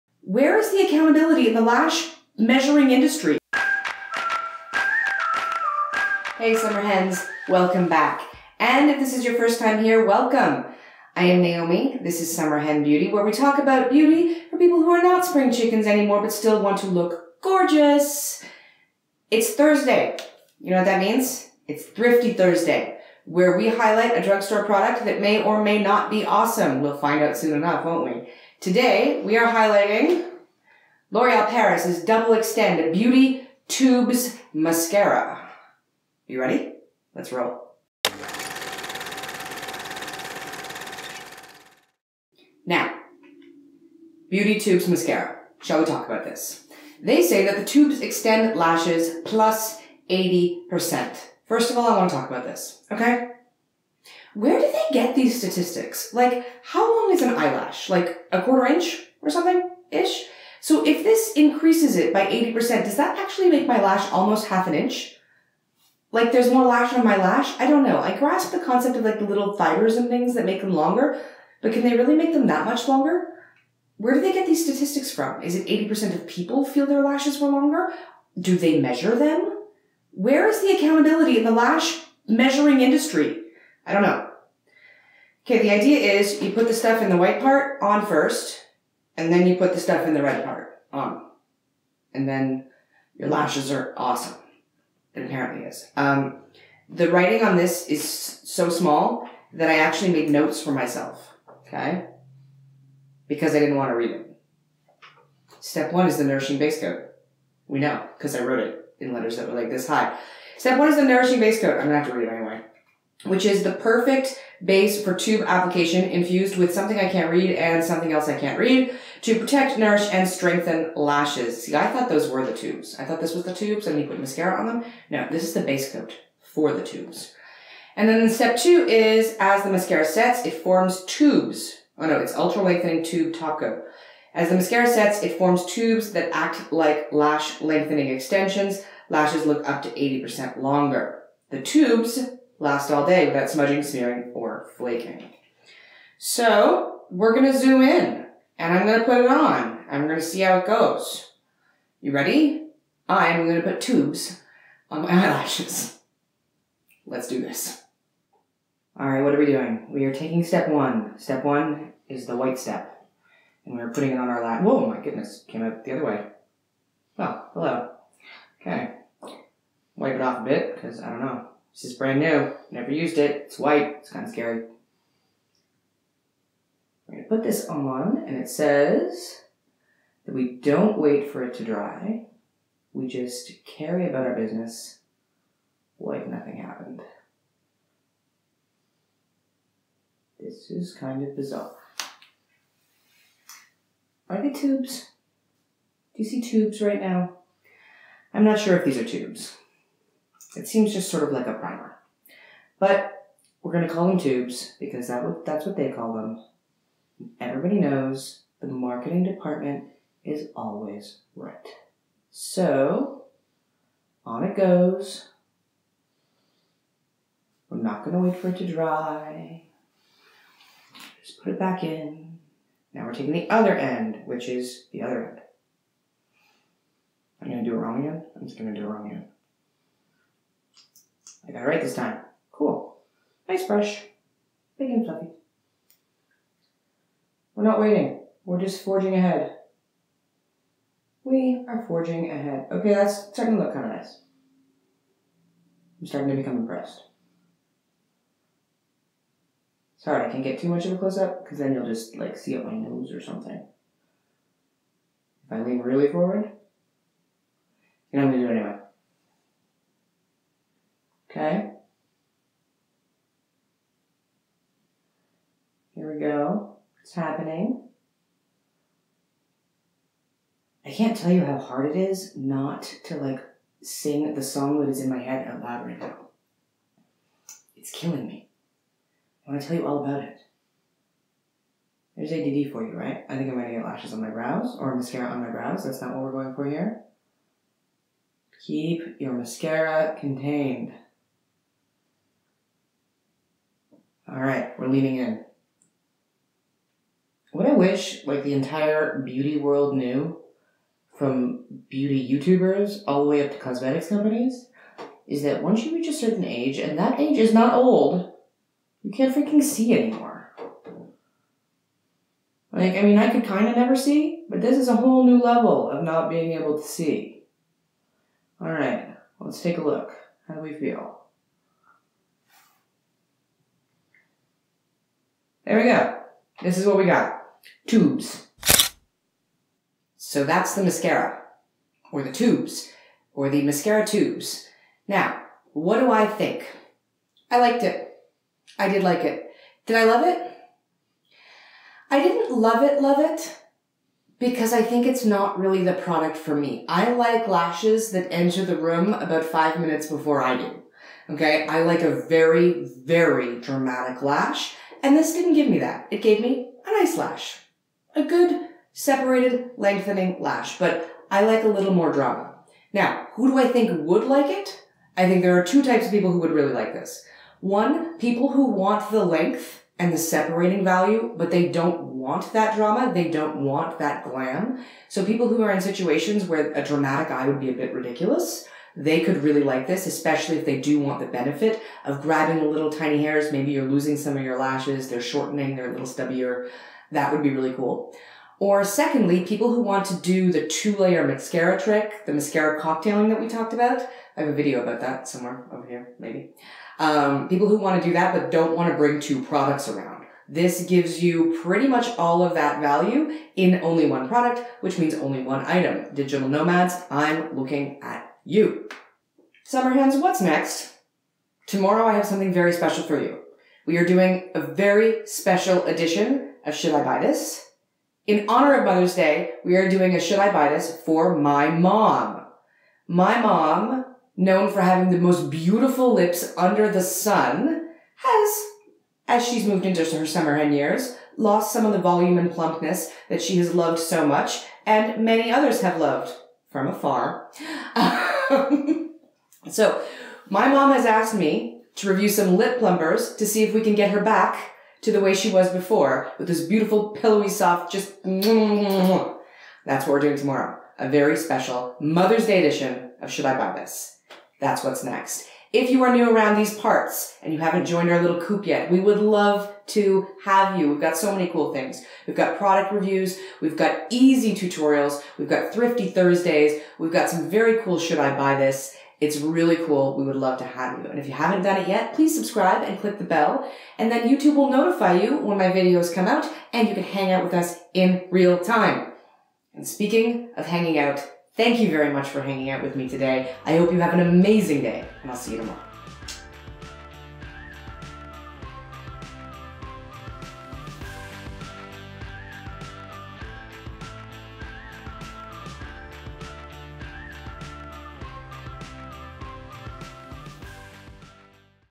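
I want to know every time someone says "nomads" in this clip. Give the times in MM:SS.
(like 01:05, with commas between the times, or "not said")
06:46.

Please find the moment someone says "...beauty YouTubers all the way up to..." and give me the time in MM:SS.
05:01.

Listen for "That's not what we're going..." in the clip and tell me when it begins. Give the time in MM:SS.
04:45.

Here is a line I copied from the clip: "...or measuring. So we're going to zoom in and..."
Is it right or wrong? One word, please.
wrong.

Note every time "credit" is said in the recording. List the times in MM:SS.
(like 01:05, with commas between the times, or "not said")
not said.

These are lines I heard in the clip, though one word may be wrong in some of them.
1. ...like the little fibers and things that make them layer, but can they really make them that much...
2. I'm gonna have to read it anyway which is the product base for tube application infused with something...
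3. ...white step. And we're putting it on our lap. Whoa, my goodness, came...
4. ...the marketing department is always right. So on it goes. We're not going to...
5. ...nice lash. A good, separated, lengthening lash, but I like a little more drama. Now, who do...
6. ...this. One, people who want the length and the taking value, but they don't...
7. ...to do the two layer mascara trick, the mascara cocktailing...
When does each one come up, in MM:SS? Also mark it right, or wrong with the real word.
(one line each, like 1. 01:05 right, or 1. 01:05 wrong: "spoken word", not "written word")
1. 01:09 wrong: "longer", not "layer"
2. 01:51 wrong: "perfect", not "product"
3. 02:42 right
4. 03:28 right
5. 05:56 right
6. 06:06 wrong: "separating", not "taking"
7. 06:30 right.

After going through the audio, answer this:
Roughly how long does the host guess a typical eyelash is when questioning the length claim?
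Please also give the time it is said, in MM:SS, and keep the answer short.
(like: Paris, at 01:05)
A quarter inch, at 00:58.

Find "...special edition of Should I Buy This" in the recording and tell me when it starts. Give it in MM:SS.
06:55.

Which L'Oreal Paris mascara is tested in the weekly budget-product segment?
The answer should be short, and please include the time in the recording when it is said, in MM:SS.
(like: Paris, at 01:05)
Double Extend Beauty Tubes, at 00:32.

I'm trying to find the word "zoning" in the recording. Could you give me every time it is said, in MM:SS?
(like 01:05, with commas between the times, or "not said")
not said.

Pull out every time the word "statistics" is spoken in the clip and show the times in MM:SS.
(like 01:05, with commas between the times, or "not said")
00:55, 01:14.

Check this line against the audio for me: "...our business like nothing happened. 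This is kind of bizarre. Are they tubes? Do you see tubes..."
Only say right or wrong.
right.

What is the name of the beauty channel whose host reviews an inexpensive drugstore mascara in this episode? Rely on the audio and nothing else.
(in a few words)
Summer Hen Beauty.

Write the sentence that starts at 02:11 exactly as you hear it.
Oh no, it's ultra lengthening tube top coat.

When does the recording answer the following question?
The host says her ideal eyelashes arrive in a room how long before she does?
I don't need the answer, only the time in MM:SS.
05:49.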